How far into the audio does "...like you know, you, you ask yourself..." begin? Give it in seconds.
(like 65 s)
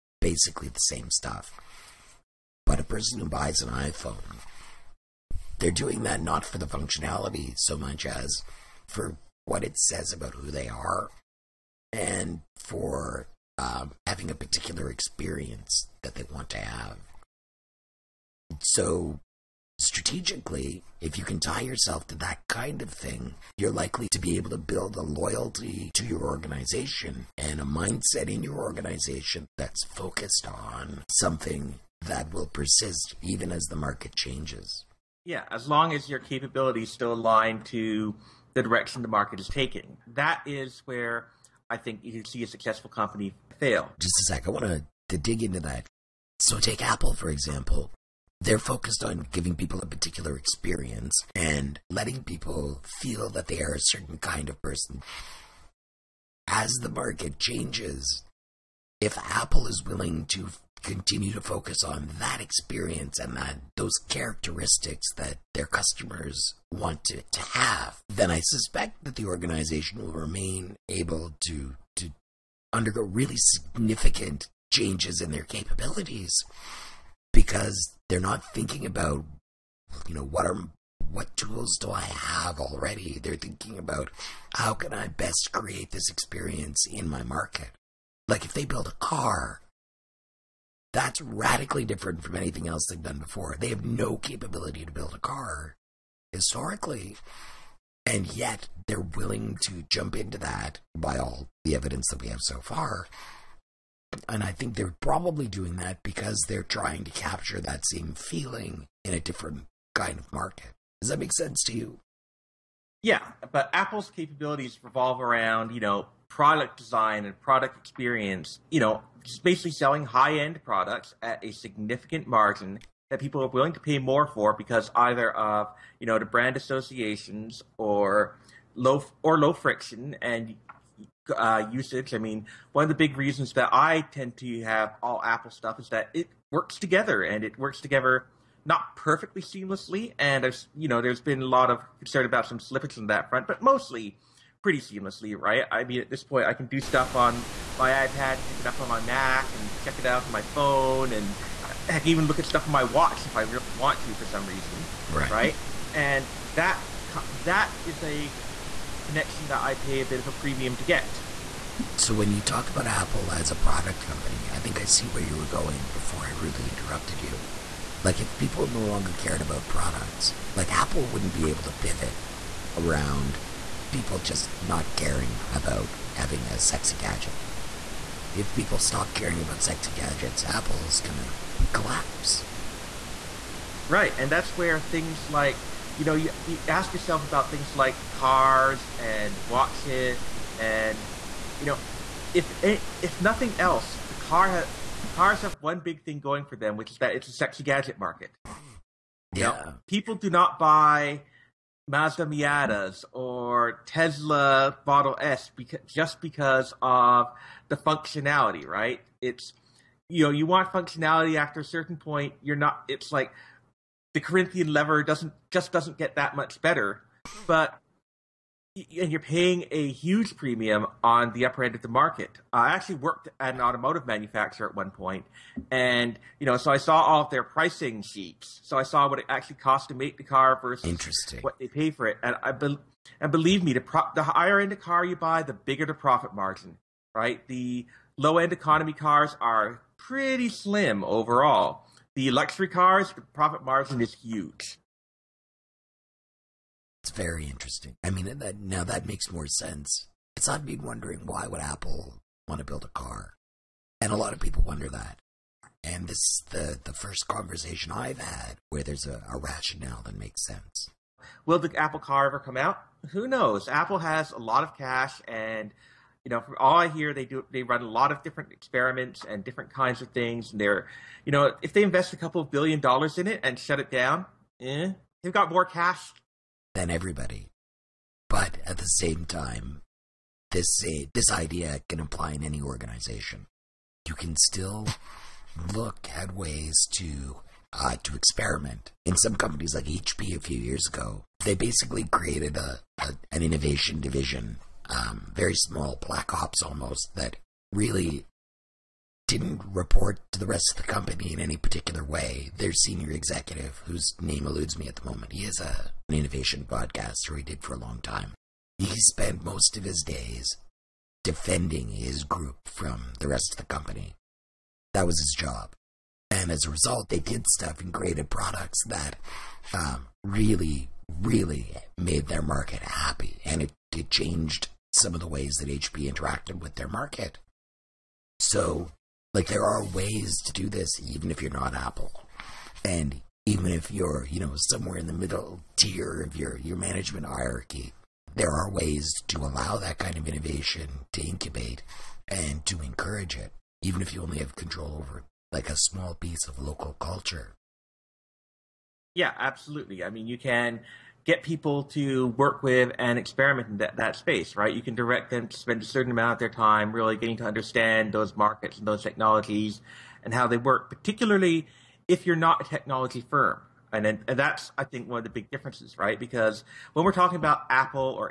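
185 s.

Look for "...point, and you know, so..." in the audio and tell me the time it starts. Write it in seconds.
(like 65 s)
224 s.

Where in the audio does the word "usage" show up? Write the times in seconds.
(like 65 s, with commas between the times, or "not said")
131 s.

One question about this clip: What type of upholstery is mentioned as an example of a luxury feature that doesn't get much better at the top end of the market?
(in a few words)
Corinthian leather.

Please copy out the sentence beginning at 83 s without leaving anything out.
They're thinking about how can I best create this experience in my market?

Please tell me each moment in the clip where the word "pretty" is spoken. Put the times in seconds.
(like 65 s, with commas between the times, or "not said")
144 s, 239 s.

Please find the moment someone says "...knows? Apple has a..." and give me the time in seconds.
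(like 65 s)
263 s.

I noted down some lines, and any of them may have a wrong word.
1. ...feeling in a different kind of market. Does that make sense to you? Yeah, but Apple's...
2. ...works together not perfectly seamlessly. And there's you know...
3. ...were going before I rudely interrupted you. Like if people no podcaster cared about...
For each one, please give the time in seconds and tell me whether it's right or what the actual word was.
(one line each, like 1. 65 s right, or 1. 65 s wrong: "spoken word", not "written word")
1. 108 s right
2. 137 s right
3. 165 s wrong: "longer", not "podcaster".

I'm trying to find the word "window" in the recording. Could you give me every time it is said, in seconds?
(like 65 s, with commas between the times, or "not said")
not said.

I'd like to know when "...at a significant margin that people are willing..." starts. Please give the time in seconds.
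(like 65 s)
121 s.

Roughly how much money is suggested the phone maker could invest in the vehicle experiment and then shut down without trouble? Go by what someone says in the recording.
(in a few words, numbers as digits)
A couple of billion dollars.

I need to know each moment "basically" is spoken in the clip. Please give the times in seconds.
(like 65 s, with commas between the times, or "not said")
0 s, 119 s, 291 s.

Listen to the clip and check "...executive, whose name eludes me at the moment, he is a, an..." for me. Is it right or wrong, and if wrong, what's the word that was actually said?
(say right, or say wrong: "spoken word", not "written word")
right.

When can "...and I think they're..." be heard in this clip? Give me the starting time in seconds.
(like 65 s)
104 s.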